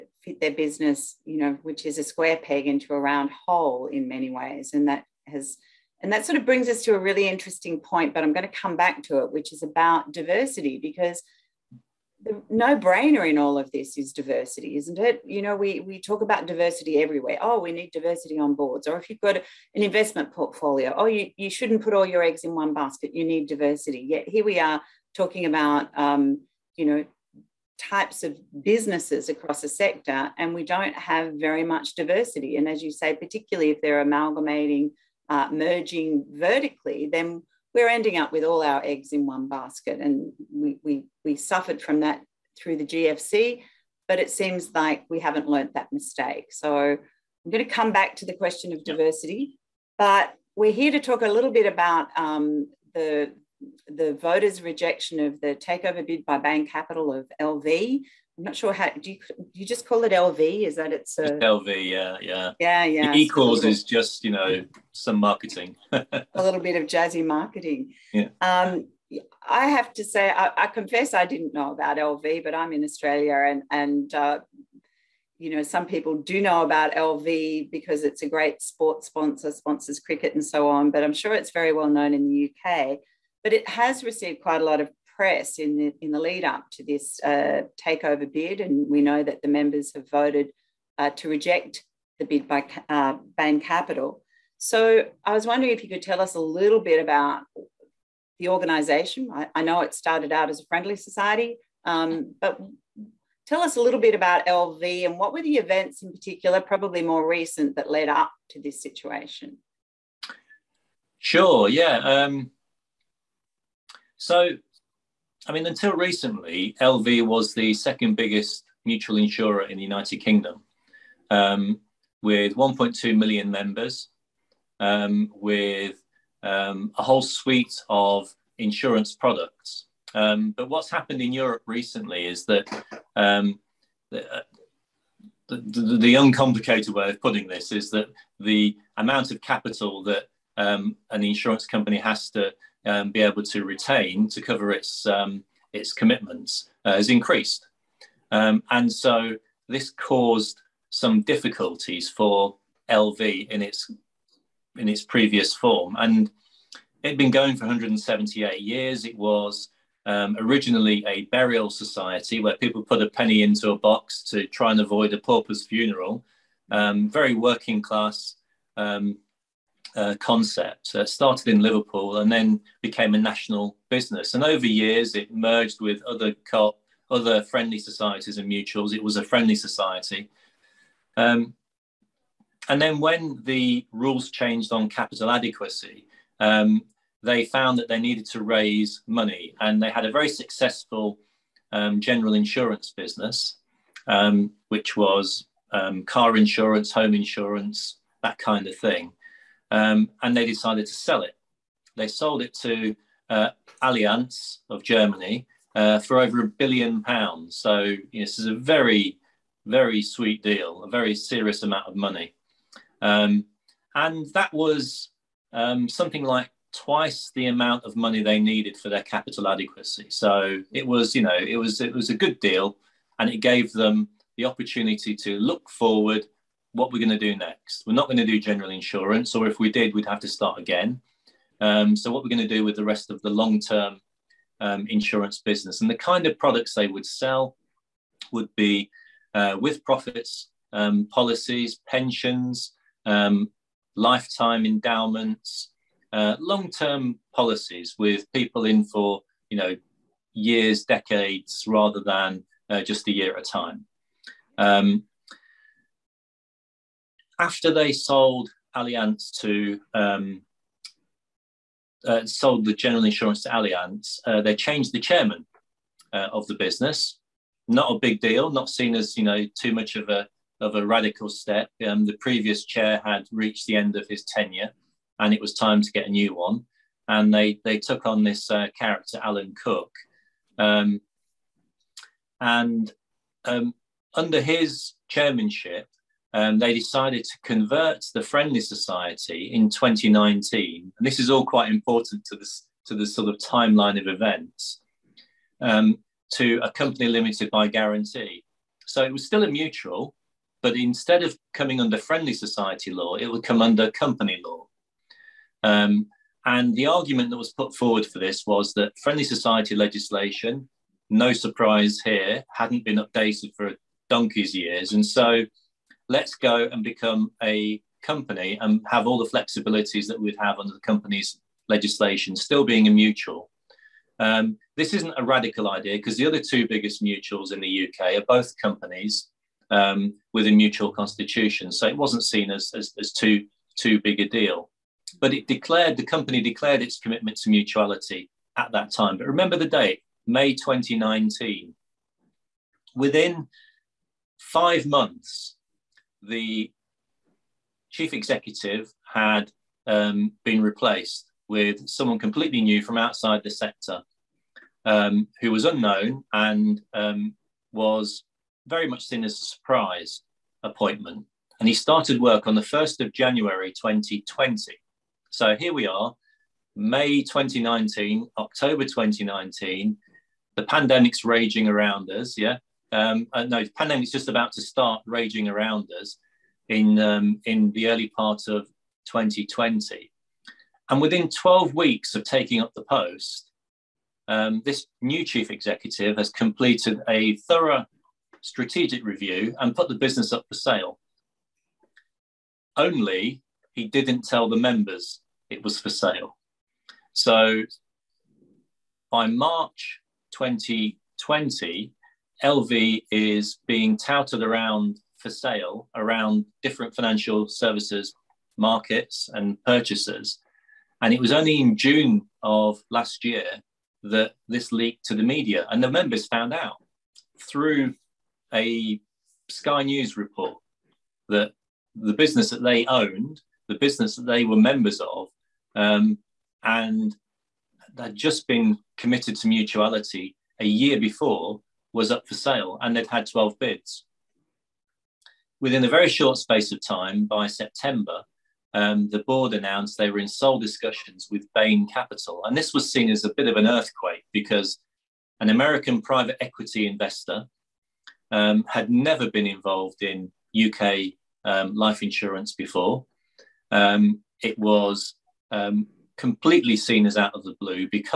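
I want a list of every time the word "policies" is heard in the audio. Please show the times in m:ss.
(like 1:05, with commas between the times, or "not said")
4:01, 4:07.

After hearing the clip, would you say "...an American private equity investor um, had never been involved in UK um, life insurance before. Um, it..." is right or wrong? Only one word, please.
right.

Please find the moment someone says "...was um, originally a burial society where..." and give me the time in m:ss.
2:39.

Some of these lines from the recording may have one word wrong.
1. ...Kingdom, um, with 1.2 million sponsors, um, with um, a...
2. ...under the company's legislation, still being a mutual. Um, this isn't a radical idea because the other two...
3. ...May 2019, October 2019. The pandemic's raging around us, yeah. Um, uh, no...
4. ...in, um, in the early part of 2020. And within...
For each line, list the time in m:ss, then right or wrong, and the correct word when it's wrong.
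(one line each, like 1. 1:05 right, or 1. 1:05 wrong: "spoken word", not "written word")
1. 2:00 wrong: "members", not "sponsors"
2. 5:20 right
3. 6:06 right
4. 6:16 right.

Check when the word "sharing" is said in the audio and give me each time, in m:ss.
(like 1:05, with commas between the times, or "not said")
not said.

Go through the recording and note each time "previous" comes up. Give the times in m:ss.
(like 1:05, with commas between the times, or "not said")
2:35, 4:32.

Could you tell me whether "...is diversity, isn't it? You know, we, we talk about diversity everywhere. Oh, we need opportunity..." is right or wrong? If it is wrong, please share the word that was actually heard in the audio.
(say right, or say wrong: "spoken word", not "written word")
wrong: "diversity", not "opportunity".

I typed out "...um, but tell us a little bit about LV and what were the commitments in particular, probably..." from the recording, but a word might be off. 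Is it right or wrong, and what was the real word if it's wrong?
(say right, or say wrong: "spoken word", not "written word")
wrong: "events", not "commitments".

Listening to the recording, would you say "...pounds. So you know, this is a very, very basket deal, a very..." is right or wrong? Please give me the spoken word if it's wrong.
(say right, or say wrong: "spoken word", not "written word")
wrong: "sweet", not "basket".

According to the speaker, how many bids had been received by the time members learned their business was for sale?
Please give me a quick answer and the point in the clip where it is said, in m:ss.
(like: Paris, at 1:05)
12, at 7:13.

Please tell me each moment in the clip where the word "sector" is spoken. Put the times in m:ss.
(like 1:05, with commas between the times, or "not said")
0:29, 5:53.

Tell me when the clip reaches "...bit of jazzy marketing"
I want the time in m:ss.
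1:06.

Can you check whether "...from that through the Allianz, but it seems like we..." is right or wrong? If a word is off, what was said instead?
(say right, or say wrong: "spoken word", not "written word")
wrong: "GFC", not "Allianz".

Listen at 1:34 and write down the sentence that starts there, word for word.
So I was wondering if you could tell us a little bit about the organisation.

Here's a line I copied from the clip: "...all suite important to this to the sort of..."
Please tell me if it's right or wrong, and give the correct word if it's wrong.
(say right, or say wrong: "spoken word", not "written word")
wrong: "quite", not "suite".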